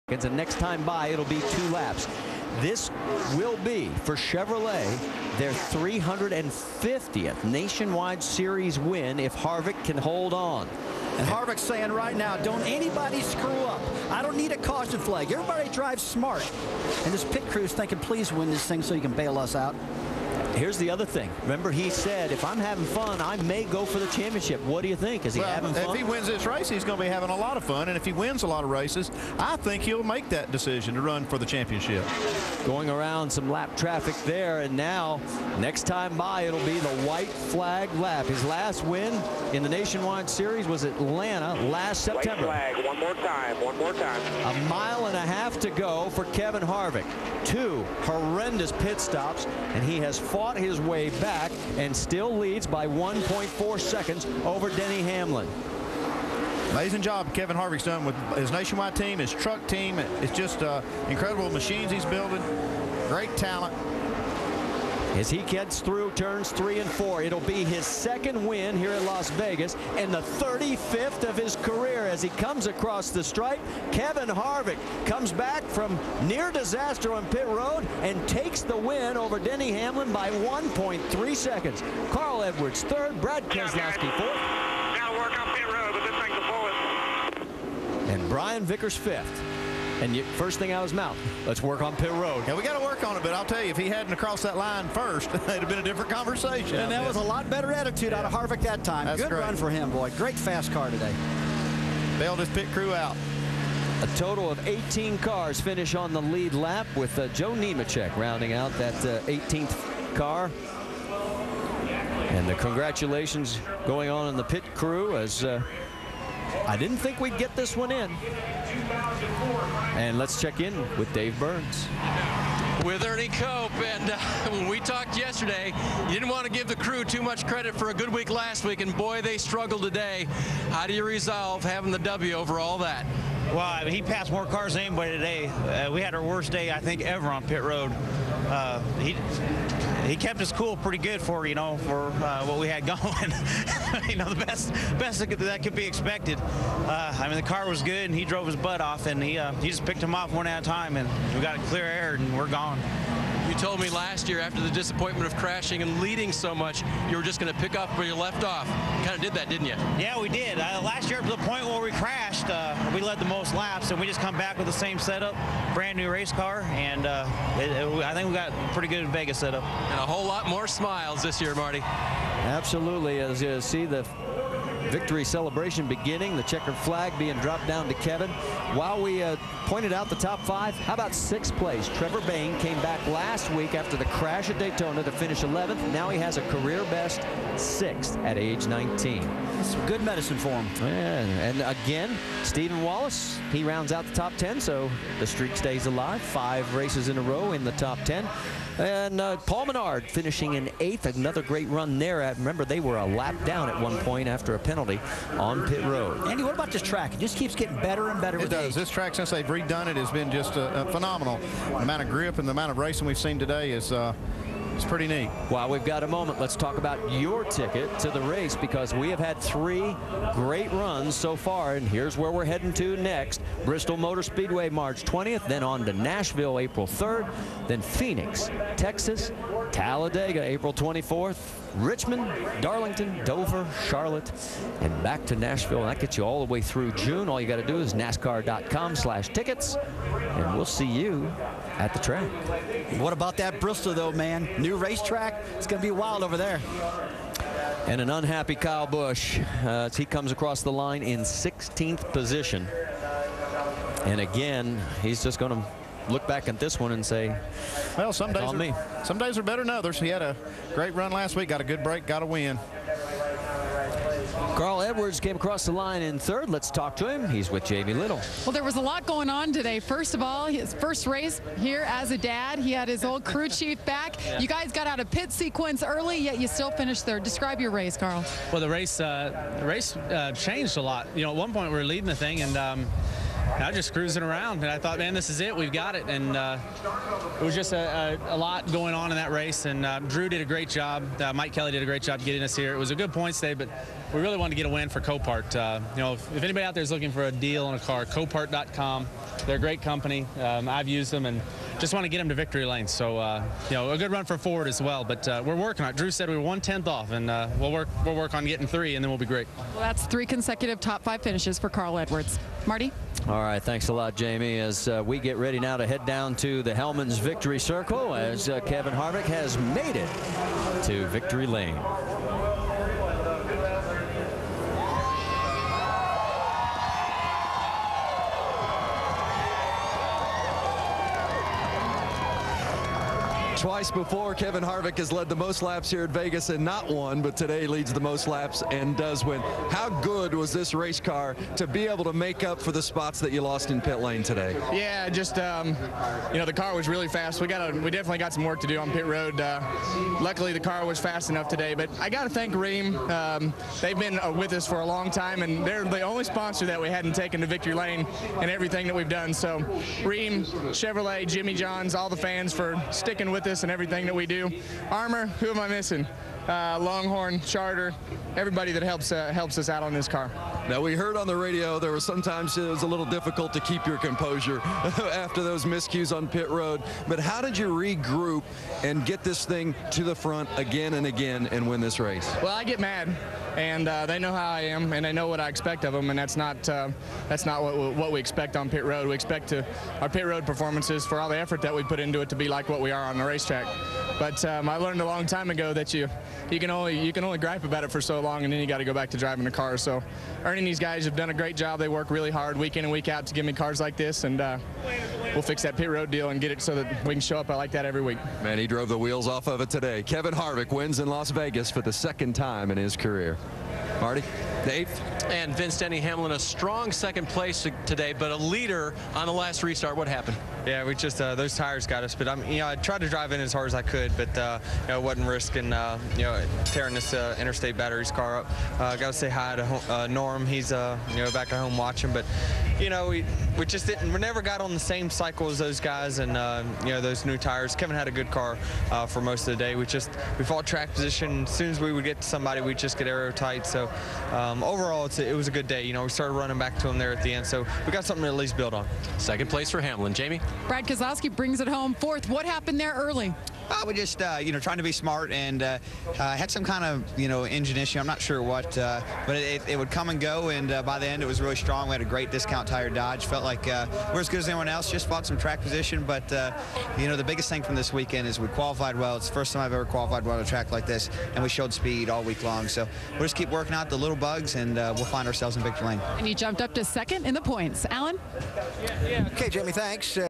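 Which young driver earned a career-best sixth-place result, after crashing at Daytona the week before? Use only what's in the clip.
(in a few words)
Trevor Bayne.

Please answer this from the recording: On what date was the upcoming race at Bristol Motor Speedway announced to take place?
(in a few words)
March 20th.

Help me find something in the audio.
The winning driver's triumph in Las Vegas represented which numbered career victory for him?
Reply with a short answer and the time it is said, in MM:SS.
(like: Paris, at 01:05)
35th, at 01:10.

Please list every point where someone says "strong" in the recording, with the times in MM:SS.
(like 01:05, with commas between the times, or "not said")
06:56, 07:41.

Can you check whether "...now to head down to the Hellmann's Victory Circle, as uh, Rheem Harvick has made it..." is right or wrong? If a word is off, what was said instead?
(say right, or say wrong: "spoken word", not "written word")
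wrong: "Kevin", not "Rheem".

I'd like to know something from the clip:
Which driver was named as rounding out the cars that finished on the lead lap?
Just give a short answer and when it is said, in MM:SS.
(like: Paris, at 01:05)
Joe Nemechek, at 01:47.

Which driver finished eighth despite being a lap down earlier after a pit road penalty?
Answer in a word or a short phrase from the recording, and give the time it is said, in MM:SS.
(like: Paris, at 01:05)
Paul Menard, at 03:19.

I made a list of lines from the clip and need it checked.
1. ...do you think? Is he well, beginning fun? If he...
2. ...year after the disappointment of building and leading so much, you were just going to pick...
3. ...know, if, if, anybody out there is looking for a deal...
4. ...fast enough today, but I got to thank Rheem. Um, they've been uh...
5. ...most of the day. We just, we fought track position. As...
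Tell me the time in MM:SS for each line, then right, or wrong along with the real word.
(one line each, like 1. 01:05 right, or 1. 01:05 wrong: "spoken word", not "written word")
1. 00:24 wrong: "having", not "beginning"
2. 02:34 wrong: "crashing", not "building"
3. 04:56 right
4. 05:50 right
5. 07:19 right.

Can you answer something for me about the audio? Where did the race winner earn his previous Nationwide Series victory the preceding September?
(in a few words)
Atlanta.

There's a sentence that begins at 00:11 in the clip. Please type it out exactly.
And Harvick's saying right now, don't anybody screw up.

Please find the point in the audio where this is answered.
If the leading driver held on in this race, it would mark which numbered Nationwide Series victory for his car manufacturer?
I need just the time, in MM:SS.
00:05.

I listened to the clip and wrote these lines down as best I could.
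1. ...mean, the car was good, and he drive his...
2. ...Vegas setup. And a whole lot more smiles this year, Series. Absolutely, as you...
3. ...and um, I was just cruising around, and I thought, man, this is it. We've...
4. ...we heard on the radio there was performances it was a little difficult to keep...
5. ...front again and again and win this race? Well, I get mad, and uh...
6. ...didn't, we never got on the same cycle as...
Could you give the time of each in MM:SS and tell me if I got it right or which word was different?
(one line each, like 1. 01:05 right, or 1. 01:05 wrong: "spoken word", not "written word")
1. 02:27 wrong: "drove", not "drive"
2. 02:49 wrong: "Marty", not "Series"
3. 04:42 right
4. 06:10 wrong: "sometimes", not "performances"
5. 06:20 right
6. 07:13 right.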